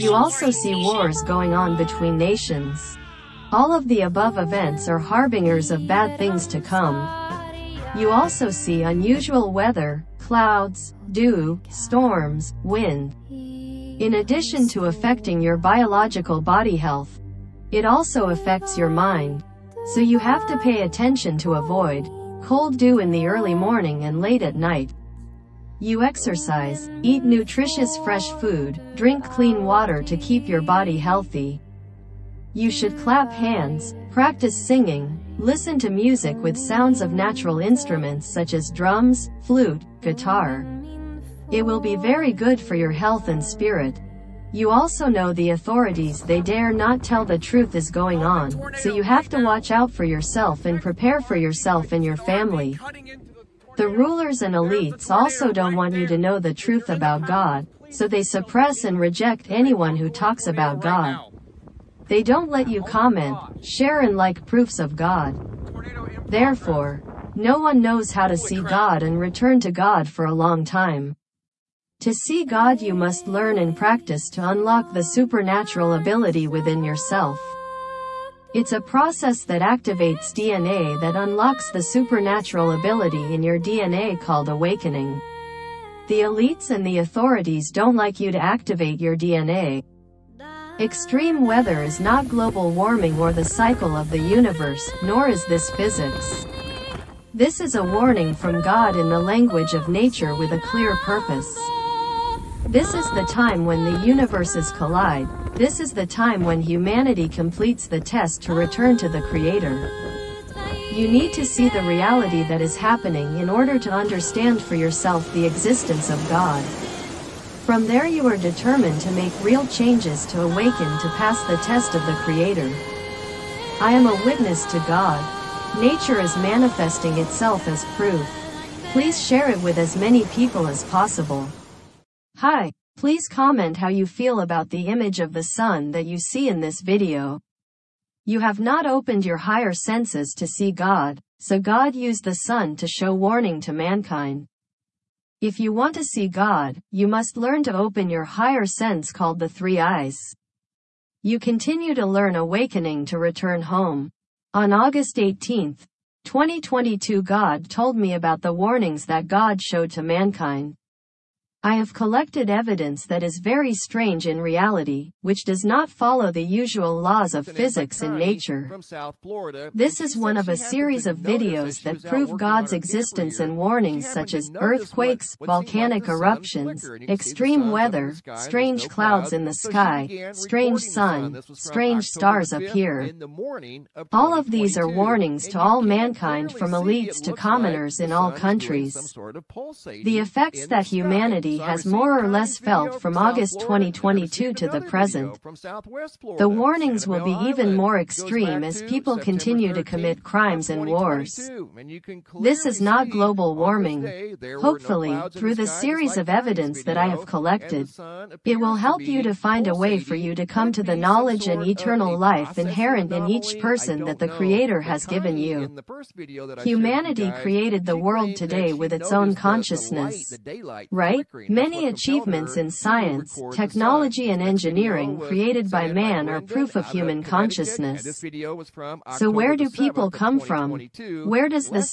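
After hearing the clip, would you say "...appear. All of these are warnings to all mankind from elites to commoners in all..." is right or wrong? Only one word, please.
right.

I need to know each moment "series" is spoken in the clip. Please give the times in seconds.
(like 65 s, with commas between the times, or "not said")
170 s, 205 s.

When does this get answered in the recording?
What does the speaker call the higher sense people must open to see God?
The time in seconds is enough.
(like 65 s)
149 s.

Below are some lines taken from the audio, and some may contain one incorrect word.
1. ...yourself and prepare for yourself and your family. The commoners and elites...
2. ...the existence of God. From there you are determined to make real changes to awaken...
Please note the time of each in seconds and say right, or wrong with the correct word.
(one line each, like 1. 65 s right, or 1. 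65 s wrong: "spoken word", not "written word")
1. 50 s wrong: "rulers", not "commoners"
2. 115 s right.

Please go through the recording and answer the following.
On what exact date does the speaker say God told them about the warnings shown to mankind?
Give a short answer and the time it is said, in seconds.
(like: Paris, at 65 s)
August 18, 2022, at 154 s.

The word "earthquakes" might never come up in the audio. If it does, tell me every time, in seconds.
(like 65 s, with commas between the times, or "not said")
174 s.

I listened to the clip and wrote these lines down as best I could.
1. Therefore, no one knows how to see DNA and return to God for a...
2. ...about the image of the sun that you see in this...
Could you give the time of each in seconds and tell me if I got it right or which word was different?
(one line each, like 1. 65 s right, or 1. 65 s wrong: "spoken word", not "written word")
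1. 66 s wrong: "God", not "DNA"
2. 134 s right.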